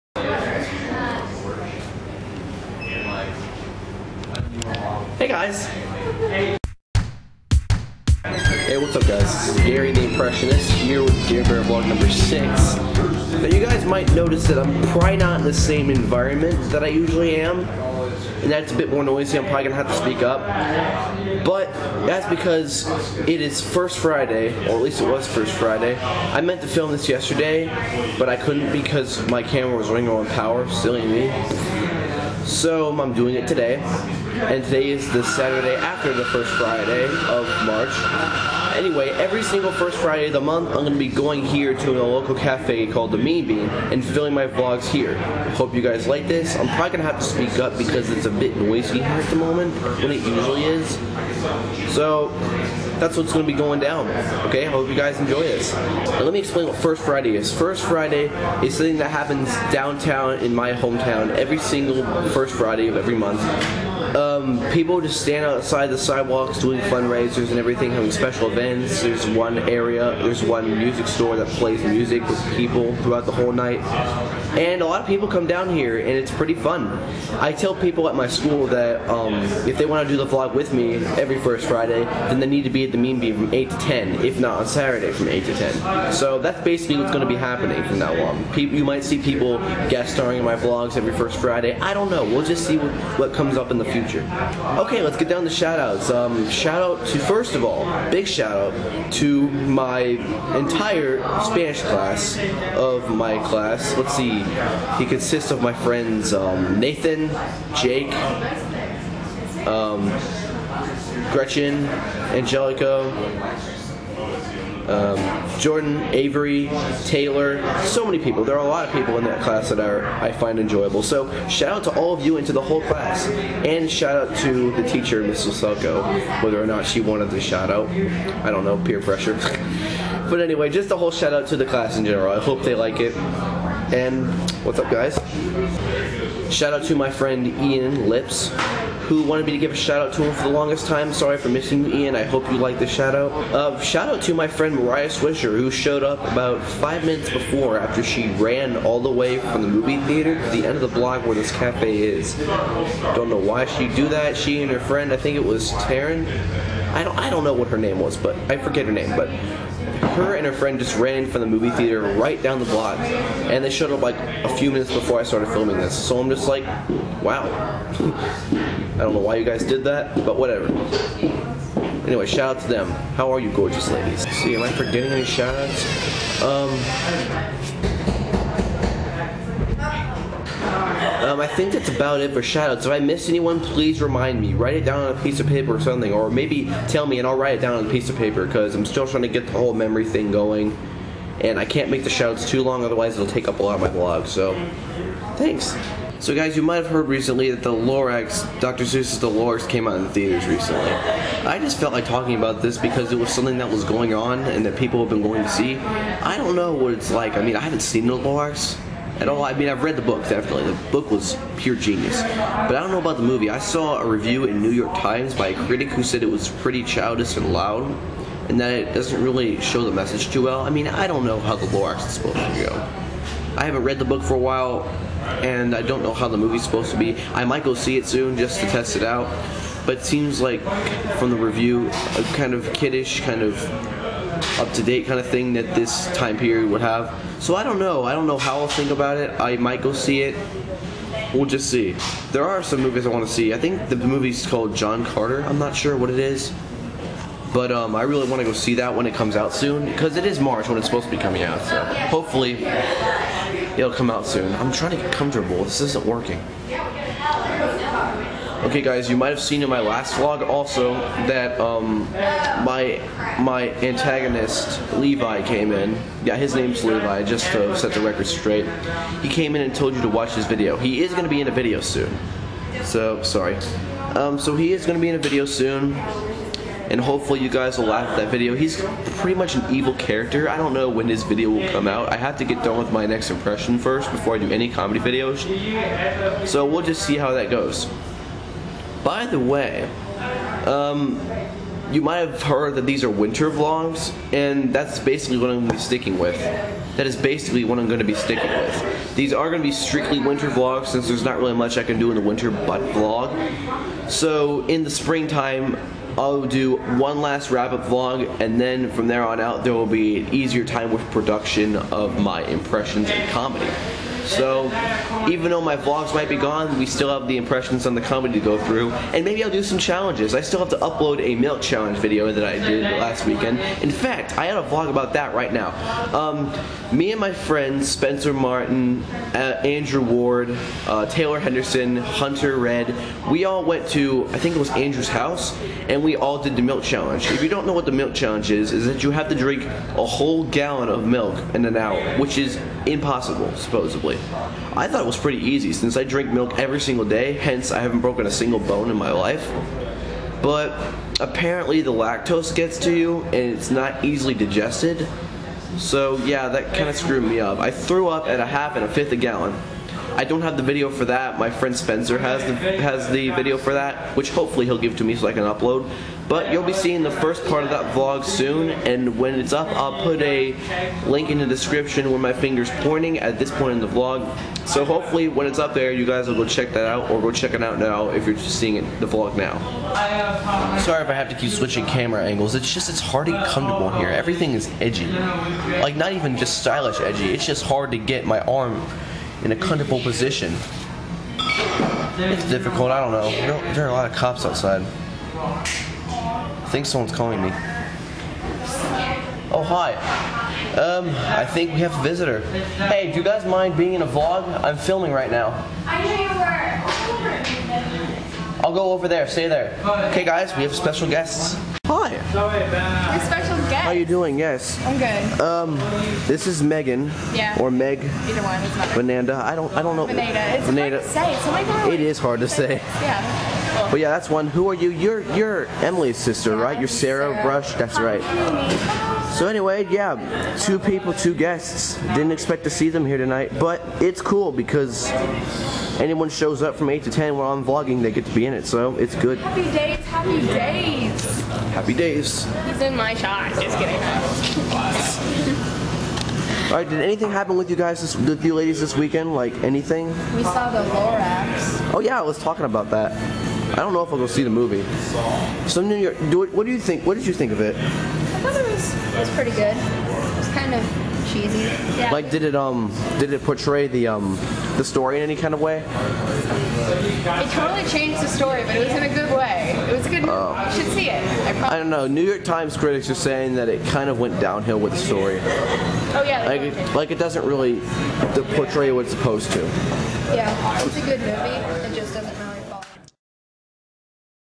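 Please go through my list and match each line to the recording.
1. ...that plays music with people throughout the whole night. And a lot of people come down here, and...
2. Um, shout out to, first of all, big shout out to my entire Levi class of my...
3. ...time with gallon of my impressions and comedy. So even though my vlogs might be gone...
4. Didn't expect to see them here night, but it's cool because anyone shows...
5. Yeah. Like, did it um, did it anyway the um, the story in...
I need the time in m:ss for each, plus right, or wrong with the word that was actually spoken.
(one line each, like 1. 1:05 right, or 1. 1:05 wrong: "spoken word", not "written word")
1. 1:11 right
2. 1:36 wrong: "Spanish", not "Levi"
3. 5:10 wrong: "production", not "gallon"
4. 7:12 wrong: "tonight", not "night"
5. 7:41 wrong: "portray", not "anyway".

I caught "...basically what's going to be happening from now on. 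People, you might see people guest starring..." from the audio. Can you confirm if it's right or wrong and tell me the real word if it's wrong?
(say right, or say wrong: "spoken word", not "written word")
right.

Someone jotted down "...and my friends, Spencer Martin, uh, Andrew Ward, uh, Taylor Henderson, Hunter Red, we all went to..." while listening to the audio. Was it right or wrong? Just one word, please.
right.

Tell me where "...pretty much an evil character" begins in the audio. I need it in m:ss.
4:39.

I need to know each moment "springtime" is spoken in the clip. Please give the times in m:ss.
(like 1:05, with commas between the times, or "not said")
5:04.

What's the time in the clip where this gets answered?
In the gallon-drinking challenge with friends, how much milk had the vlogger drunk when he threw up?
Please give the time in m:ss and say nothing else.
5:58.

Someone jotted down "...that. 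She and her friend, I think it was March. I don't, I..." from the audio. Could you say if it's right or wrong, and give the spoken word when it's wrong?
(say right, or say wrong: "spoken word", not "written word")
wrong: "Taryn", not "March".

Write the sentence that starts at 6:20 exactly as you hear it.
Sorry if I have to keep switching camera angles.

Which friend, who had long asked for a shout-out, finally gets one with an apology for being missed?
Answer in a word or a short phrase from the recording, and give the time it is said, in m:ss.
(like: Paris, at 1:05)
Ian Lips, at 2:17.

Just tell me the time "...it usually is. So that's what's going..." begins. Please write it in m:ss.
0:50.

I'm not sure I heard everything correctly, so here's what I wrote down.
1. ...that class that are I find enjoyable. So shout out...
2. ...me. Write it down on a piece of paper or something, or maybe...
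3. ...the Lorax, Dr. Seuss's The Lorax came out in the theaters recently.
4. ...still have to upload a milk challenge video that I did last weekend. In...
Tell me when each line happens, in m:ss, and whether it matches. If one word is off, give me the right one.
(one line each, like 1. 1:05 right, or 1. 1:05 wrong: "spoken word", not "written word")
1. 1:59 right
2. 3:04 right
3. 3:17 right
4. 5:20 right.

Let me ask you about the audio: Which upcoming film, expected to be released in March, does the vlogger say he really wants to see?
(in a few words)
John Carter.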